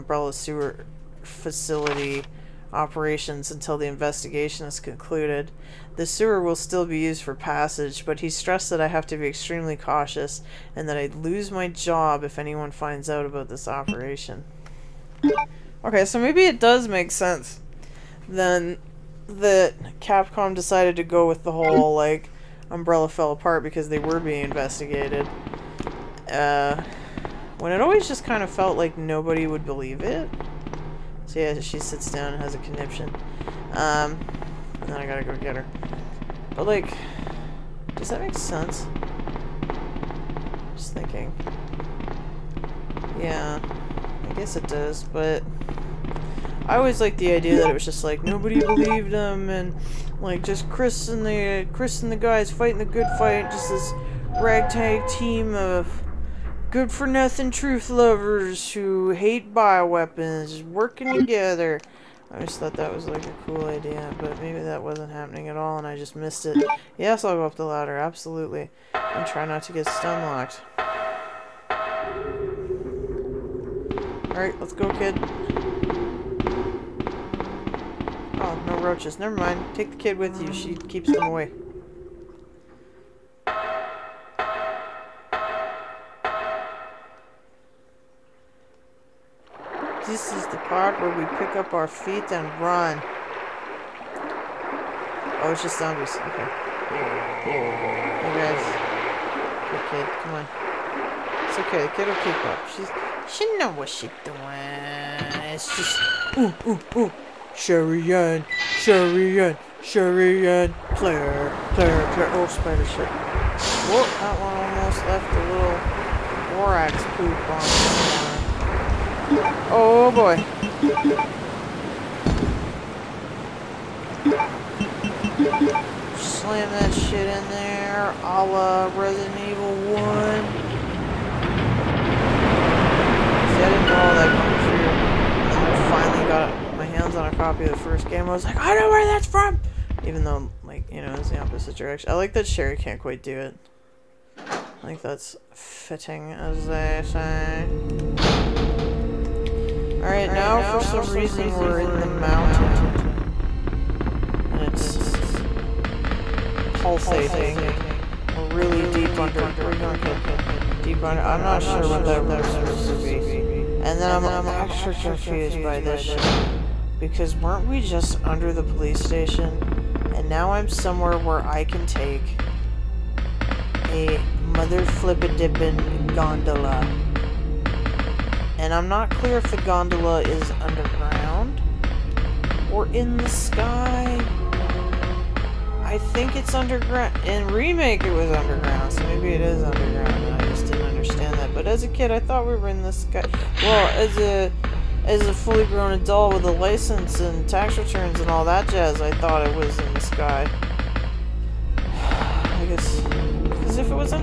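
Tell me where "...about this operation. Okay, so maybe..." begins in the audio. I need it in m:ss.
0:13.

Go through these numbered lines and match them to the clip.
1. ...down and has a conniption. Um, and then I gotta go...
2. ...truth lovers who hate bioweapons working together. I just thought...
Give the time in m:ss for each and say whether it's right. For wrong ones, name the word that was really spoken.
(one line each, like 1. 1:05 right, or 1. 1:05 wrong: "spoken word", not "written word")
1. 0:32 right
2. 0:57 right.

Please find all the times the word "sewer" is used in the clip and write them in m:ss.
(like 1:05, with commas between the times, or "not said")
0:00, 0:06.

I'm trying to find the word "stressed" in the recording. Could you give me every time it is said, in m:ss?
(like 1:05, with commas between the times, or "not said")
0:08.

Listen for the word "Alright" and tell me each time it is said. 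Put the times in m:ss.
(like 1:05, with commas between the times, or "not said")
1:14, 2:29.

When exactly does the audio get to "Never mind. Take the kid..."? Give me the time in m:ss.
1:19.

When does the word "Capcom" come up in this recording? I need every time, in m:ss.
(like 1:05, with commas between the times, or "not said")
0:19.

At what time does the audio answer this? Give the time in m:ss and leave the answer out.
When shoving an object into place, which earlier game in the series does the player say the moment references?
2:08.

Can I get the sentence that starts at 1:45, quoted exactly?
It's just ooh ooh ooh and Sherry and Claire, Claire, Claire.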